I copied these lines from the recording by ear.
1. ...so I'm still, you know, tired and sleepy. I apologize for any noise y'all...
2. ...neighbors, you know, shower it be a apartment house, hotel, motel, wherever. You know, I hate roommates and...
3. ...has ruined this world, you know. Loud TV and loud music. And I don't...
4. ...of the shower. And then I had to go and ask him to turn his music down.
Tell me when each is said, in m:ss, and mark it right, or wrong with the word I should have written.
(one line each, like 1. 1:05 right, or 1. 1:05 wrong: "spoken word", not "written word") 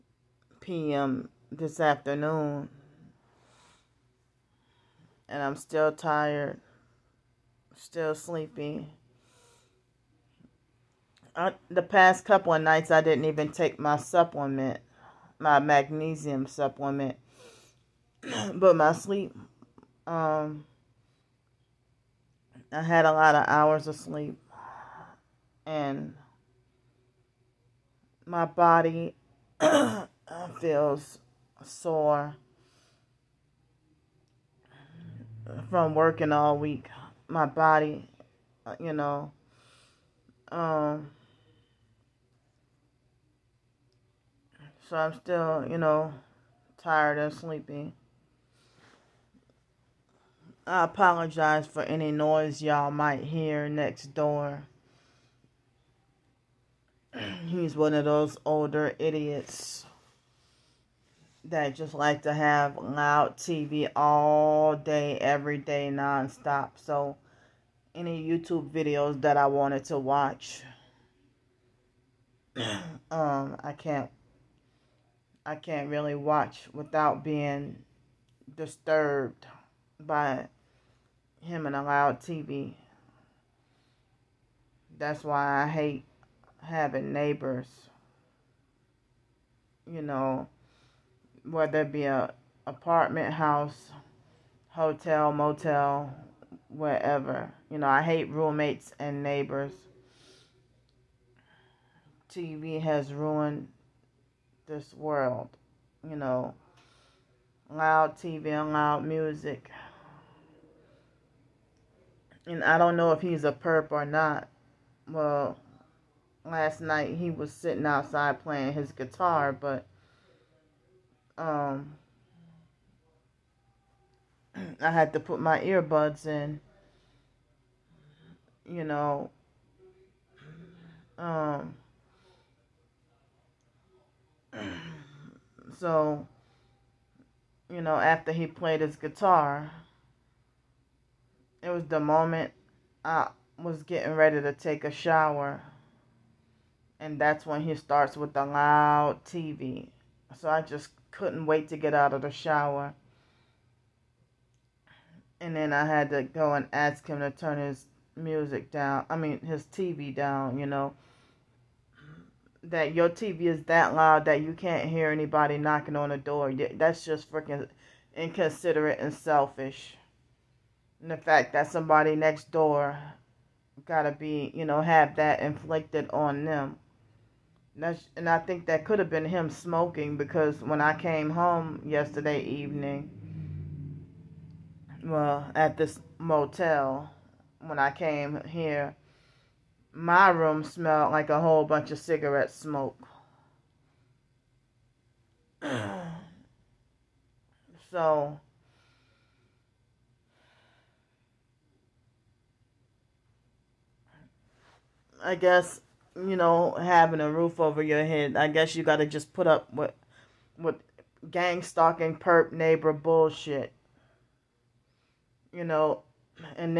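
1. 0:44 right
2. 1:27 wrong: "whether", not "shower"
3. 1:42 right
4. 2:32 right.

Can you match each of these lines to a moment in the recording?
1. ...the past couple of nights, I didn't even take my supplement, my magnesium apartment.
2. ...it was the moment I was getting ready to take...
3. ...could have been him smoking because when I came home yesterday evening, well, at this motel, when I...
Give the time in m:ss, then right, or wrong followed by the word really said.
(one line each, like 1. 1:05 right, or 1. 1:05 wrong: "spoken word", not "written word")
1. 0:11 wrong: "supplement", not "apartment"
2. 2:21 right
3. 2:58 right.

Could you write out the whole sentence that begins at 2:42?
That your TV is that loud that you can't hear anybody knocking on the door.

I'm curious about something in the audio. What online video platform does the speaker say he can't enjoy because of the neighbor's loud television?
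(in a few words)
YouTube.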